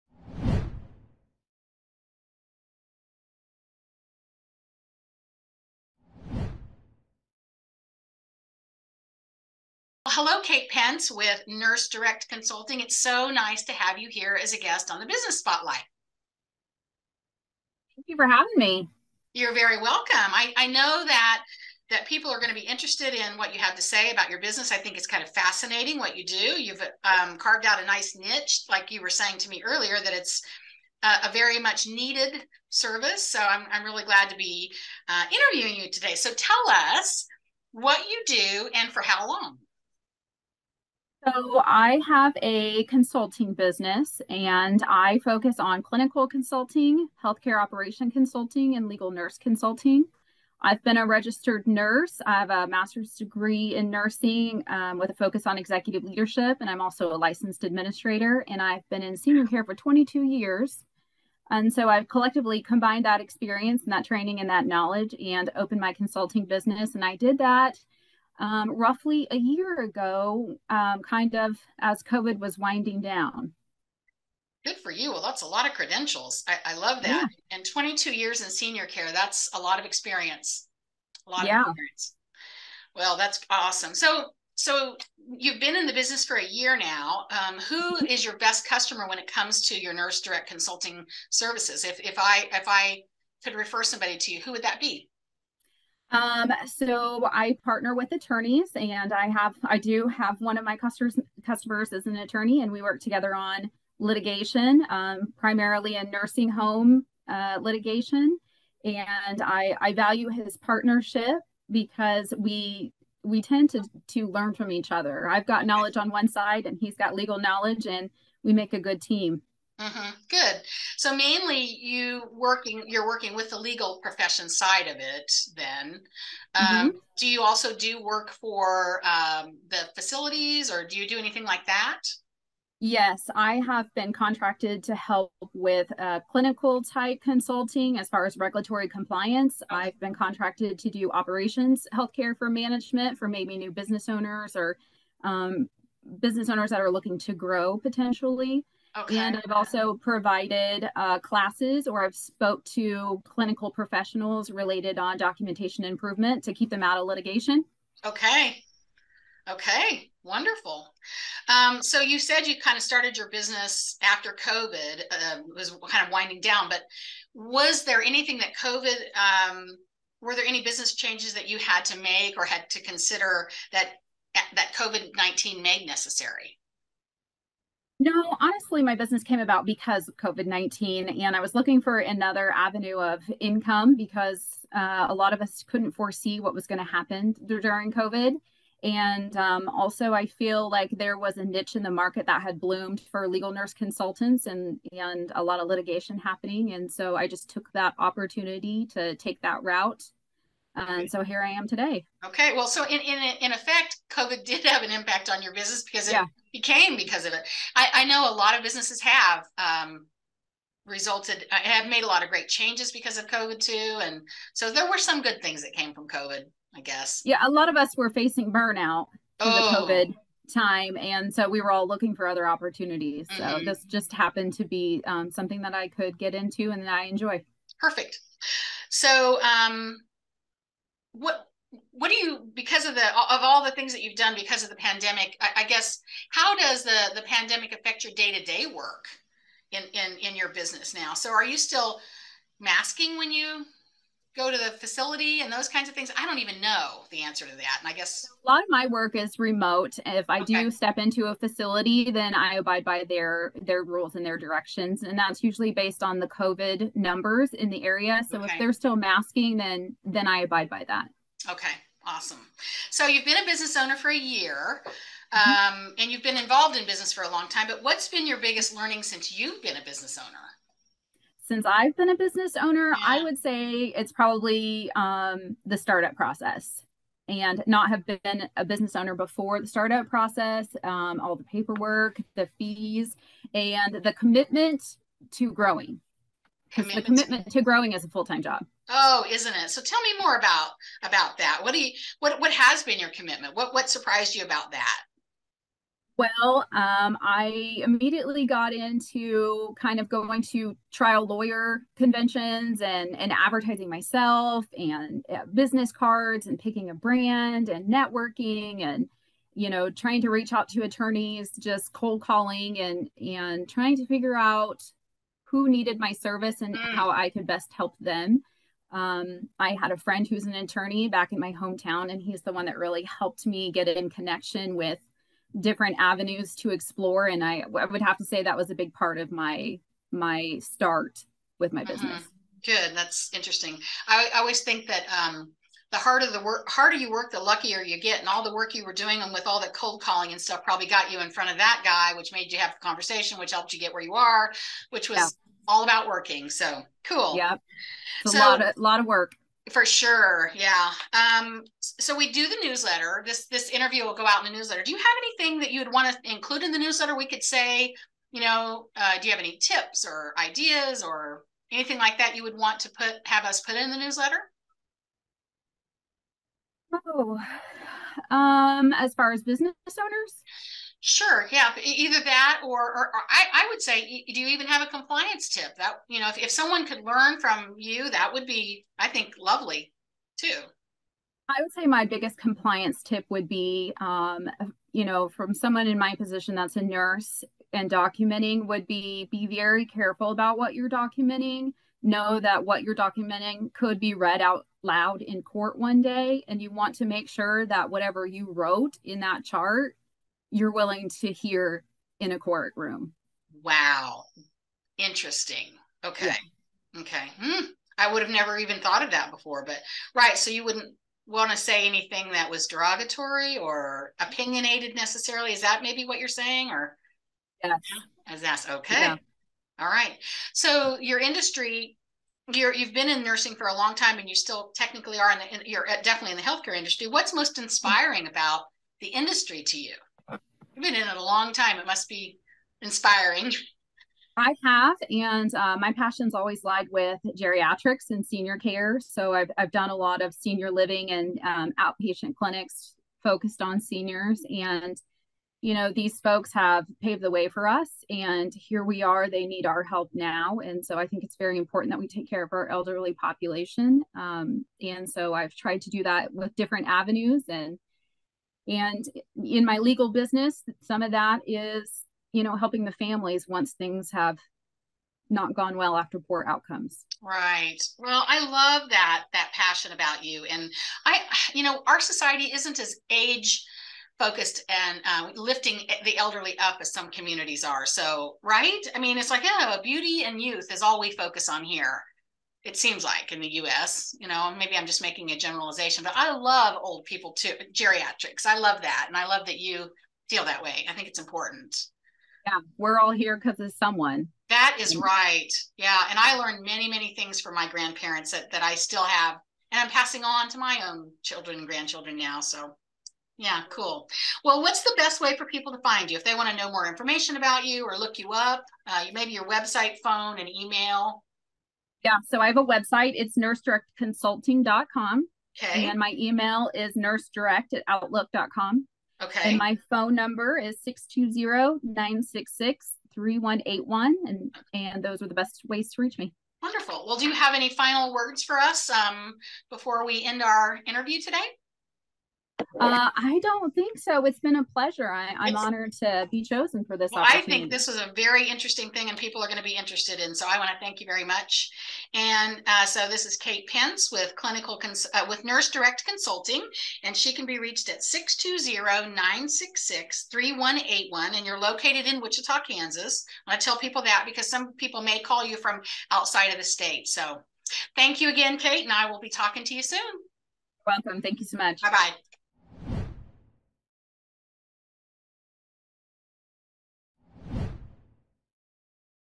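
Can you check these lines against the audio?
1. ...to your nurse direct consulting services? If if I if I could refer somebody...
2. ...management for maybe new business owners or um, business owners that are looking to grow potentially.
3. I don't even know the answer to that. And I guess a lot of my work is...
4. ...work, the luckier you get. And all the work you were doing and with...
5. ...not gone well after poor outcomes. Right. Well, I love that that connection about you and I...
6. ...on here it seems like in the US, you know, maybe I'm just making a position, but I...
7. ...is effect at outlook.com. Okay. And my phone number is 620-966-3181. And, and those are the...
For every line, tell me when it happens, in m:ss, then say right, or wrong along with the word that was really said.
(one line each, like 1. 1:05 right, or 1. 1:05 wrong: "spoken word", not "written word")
1. 1:29 right
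2. 2:22 right
3. 4:06 right
4. 5:37 right
5. 7:45 wrong: "passion", not "connection"
6. 8:01 wrong: "generalization", not "position"
7. 8:36 wrong: "nursedirect", not "effect".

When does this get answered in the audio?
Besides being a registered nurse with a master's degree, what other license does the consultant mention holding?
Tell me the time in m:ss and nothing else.
0:57.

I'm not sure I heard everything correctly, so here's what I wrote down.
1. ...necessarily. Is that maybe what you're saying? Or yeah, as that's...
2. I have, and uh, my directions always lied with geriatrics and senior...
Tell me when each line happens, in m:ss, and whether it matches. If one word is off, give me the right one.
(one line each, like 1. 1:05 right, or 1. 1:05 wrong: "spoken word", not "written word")
1. 6:54 right
2. 7:14 wrong: "passions", not "directions".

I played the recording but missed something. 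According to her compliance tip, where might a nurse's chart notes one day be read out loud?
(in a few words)
in court.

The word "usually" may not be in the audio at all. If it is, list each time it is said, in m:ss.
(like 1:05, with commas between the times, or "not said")
4:15.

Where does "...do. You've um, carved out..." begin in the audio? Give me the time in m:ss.
0:26.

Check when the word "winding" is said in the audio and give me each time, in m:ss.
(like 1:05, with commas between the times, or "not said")
1:12, 2:46.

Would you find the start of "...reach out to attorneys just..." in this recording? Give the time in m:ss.
5:10.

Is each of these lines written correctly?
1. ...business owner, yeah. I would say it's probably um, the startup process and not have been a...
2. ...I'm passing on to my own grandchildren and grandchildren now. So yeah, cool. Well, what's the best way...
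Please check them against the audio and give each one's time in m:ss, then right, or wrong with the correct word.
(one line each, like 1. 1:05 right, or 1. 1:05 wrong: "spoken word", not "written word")
1. 4:32 right
2. 8:19 wrong: "children", not "grandchildren".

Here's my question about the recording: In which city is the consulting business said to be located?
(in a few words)
Wichita, Kansas.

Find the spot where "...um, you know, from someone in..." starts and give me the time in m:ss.
6:23.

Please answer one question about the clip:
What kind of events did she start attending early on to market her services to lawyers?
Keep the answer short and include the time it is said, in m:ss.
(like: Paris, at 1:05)
trial lawyer conventions, at 5:00.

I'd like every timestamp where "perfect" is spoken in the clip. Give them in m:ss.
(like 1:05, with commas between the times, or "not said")
3:47.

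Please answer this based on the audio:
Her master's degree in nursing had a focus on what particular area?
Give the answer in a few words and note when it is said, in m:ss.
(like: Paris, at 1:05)
executive leadership, at 0:55.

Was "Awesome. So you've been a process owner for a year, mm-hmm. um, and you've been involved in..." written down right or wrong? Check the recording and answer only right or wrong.
wrong.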